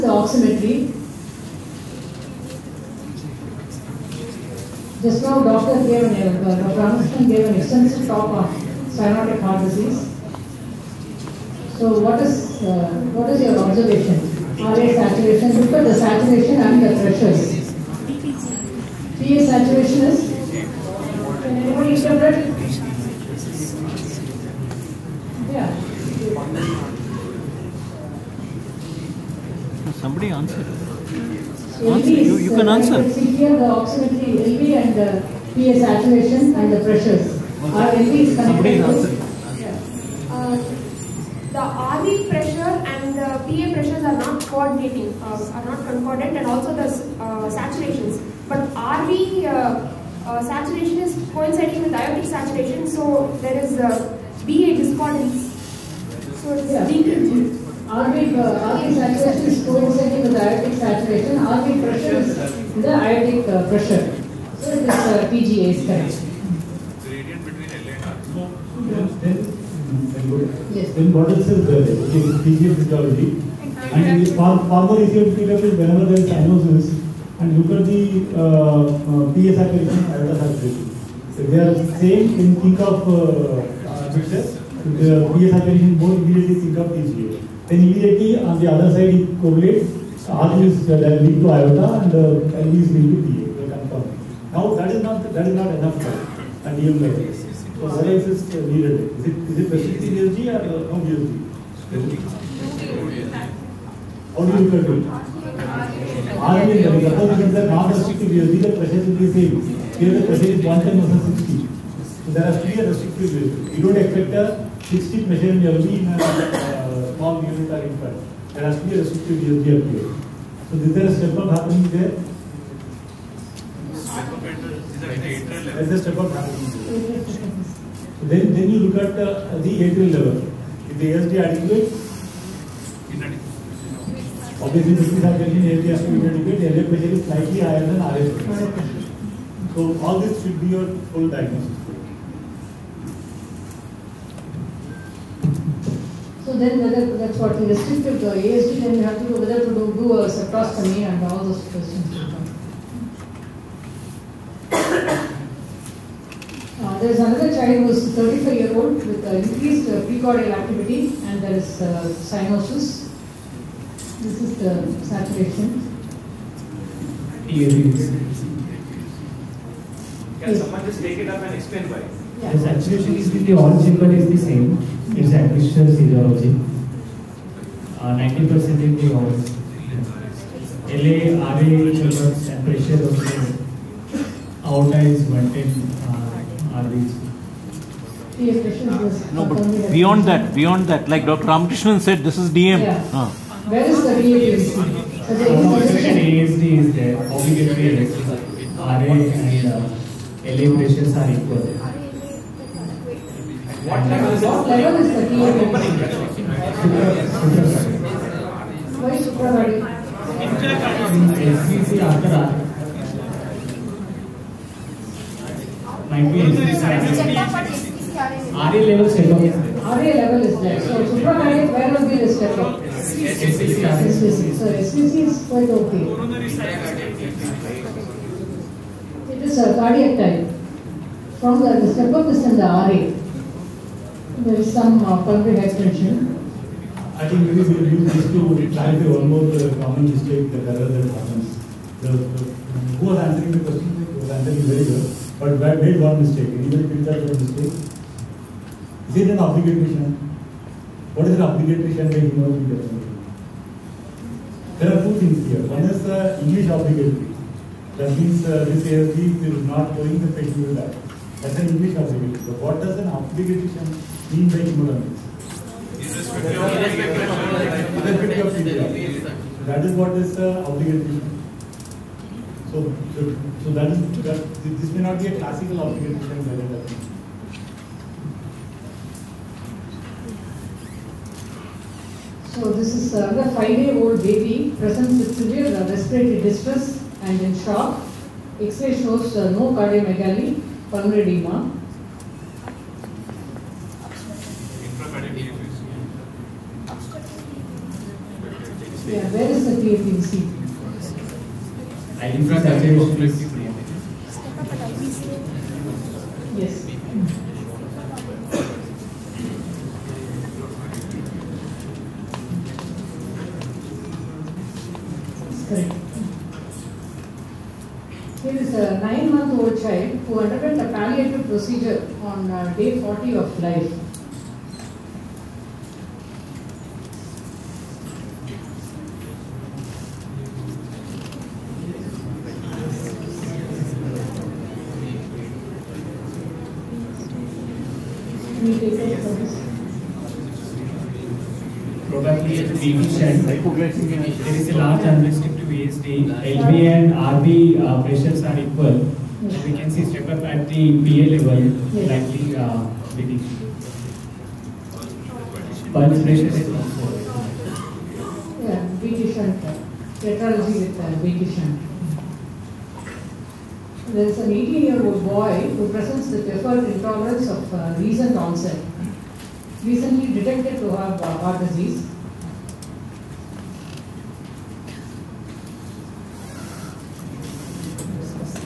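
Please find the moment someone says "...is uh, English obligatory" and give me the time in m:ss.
4:15.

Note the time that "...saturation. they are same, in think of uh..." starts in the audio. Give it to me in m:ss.
1:20.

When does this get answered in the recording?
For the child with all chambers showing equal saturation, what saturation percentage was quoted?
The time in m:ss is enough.
2:57.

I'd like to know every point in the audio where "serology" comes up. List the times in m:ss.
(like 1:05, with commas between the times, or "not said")
2:55.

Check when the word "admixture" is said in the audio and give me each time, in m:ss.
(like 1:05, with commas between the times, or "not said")
2:55.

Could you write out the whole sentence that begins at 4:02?
The, the, who was answering the question?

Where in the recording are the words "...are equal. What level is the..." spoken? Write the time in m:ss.
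3:21.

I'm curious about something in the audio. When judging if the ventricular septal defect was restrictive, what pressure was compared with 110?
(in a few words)
60.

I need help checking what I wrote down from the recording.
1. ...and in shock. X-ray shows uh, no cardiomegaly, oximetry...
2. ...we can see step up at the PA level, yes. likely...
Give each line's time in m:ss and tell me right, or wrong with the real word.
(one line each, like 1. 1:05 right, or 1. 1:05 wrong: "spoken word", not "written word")
1. 4:47 wrong: "pulmonary", not "oximetry"
2. 5:49 right.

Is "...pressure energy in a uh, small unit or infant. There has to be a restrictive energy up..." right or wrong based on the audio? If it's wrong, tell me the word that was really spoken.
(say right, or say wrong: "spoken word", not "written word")
right.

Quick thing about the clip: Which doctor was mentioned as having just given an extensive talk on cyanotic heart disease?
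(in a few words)
Dr. Anderson.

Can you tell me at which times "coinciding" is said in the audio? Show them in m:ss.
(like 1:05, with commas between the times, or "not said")
0:51, 0:59.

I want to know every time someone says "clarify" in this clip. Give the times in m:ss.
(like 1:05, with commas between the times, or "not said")
3:58.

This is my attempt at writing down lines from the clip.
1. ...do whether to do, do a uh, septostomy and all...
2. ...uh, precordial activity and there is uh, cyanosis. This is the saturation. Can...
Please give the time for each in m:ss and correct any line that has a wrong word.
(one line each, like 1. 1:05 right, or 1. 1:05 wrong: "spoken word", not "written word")
1. 2:29 right
2. 2:39 right.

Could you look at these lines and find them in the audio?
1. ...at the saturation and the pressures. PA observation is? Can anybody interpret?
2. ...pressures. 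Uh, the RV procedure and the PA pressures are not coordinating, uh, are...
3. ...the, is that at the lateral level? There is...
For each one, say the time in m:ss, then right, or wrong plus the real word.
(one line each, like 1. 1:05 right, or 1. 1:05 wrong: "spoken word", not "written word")
1. 0:15 wrong: "saturation", not "observation"
2. 0:36 wrong: "pressure", not "procedure"
3. 2:04 right.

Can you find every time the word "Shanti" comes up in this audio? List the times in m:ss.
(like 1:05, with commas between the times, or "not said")
4:11, 4:36.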